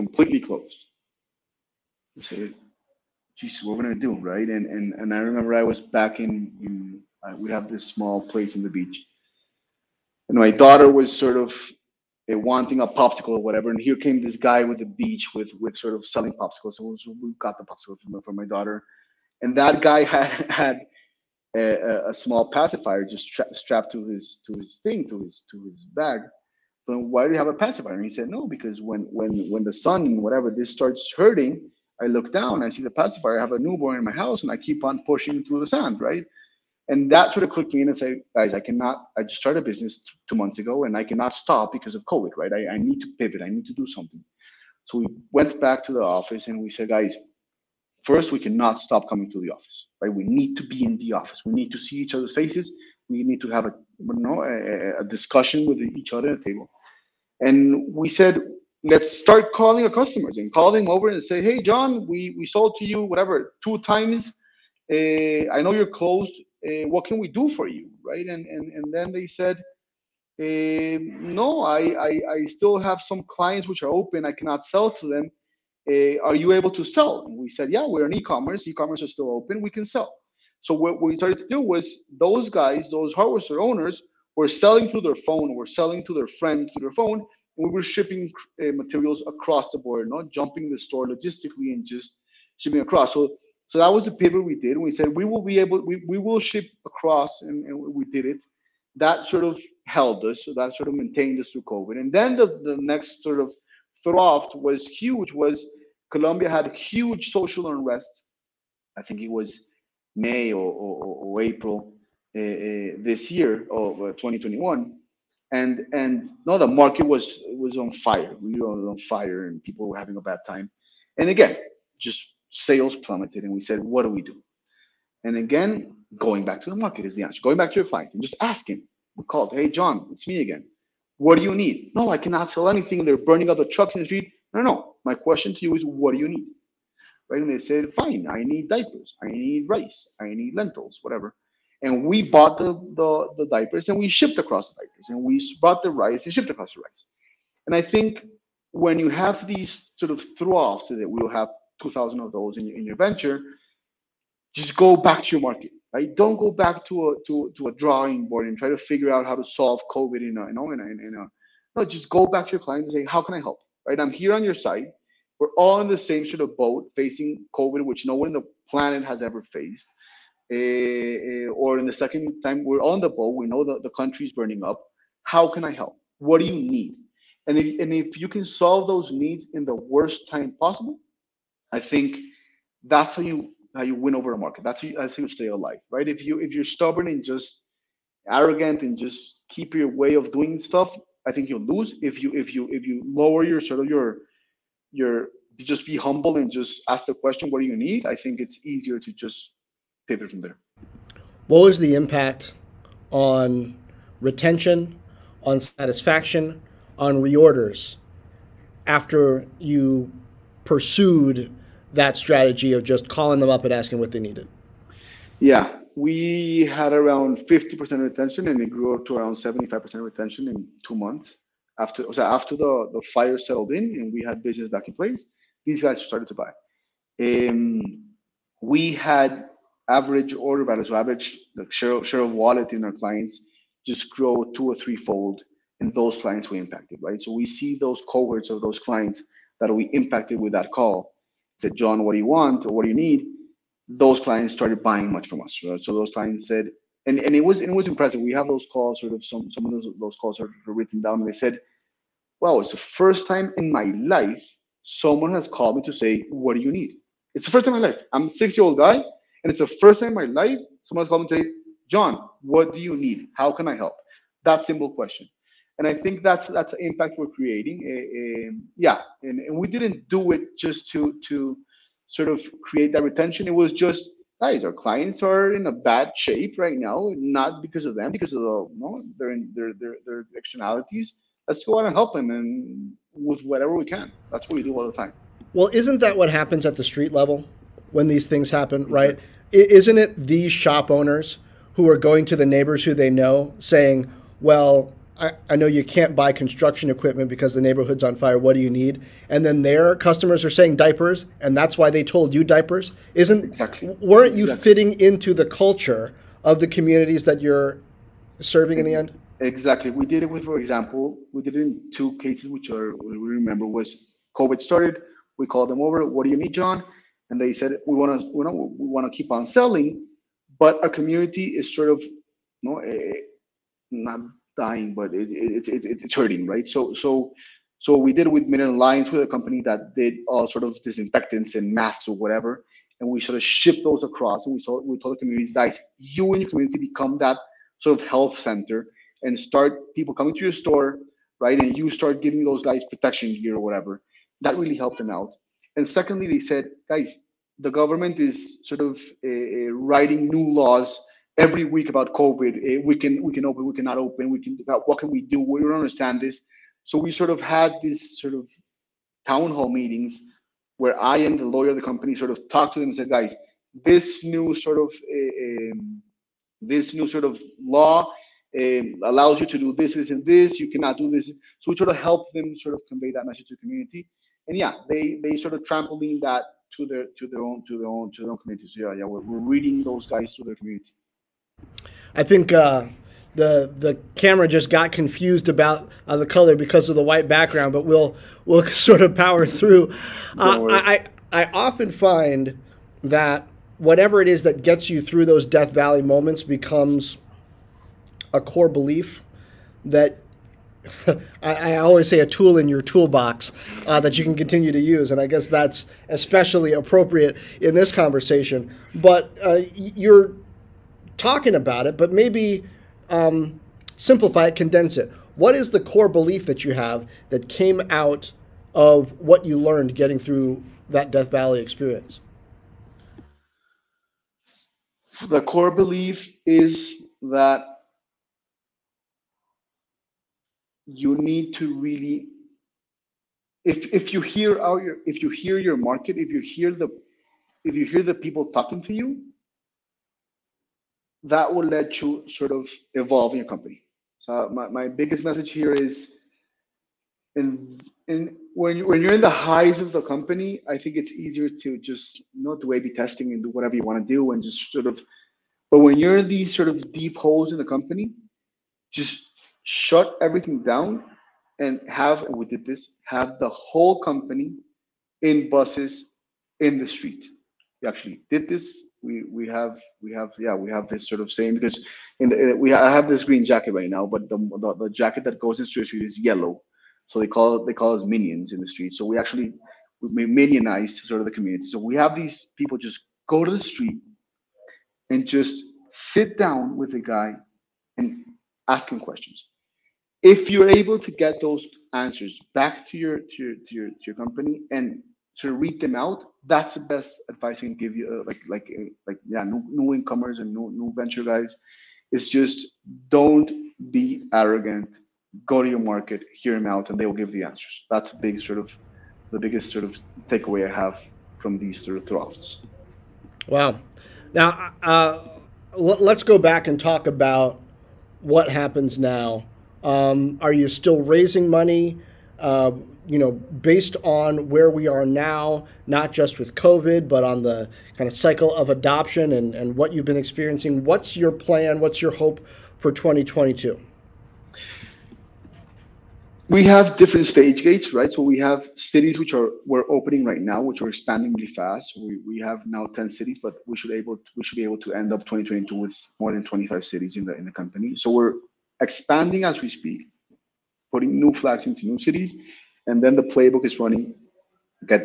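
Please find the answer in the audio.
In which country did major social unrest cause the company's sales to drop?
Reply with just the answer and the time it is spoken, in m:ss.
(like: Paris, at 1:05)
Colombia, at 1:46.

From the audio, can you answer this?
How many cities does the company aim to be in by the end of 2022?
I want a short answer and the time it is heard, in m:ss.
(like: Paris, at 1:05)
more than 25, at 9:06.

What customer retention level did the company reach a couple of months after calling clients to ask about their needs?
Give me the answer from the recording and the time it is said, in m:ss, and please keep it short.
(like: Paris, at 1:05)
75%, at 3:39.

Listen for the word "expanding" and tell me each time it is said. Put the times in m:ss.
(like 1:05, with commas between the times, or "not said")
9:00, 9:08.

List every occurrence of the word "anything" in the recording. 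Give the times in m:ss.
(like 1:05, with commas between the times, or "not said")
2:12.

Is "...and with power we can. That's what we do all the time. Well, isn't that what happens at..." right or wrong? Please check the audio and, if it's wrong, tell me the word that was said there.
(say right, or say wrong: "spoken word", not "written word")
wrong: "whatever", not "power".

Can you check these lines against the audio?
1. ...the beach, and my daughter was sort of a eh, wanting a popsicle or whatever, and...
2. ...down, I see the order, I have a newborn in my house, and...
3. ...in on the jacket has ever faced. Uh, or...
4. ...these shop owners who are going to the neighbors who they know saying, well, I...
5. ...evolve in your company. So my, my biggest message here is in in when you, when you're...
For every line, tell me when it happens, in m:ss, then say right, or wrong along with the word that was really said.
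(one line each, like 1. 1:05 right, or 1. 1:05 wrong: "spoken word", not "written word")
1. 0:08 right
2. 0:32 wrong: "pacifier", not "order"
3. 2:48 wrong: "planet", not "jacket"
4. 4:50 right
5. 7:22 right.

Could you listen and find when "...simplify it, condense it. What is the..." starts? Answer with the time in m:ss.
6:53.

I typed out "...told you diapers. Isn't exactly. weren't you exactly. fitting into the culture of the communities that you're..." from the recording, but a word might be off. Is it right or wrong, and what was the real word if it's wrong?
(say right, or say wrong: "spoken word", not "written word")
right.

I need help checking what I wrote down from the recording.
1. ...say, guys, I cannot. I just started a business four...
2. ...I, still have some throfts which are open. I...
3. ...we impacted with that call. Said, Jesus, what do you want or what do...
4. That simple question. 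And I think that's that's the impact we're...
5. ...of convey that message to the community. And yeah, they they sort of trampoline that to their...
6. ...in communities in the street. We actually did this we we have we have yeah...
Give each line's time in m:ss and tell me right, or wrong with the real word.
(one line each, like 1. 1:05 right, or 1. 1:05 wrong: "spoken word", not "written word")
1. 0:37 wrong: "two", not "four"
2. 1:12 wrong: "clients", not "throfts"
3. 3:59 wrong: "John", not "Jesus"
4. 4:24 right
5. 6:12 right
6. 7:45 wrong: "buses", not "communities".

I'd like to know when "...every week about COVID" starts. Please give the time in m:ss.
5:51.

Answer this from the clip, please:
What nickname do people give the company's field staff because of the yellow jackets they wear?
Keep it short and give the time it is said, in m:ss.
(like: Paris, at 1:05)
minions, at 7:58.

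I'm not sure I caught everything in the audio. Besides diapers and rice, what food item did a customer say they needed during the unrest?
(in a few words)
lentils.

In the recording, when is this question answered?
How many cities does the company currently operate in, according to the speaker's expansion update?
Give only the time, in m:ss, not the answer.
9:02.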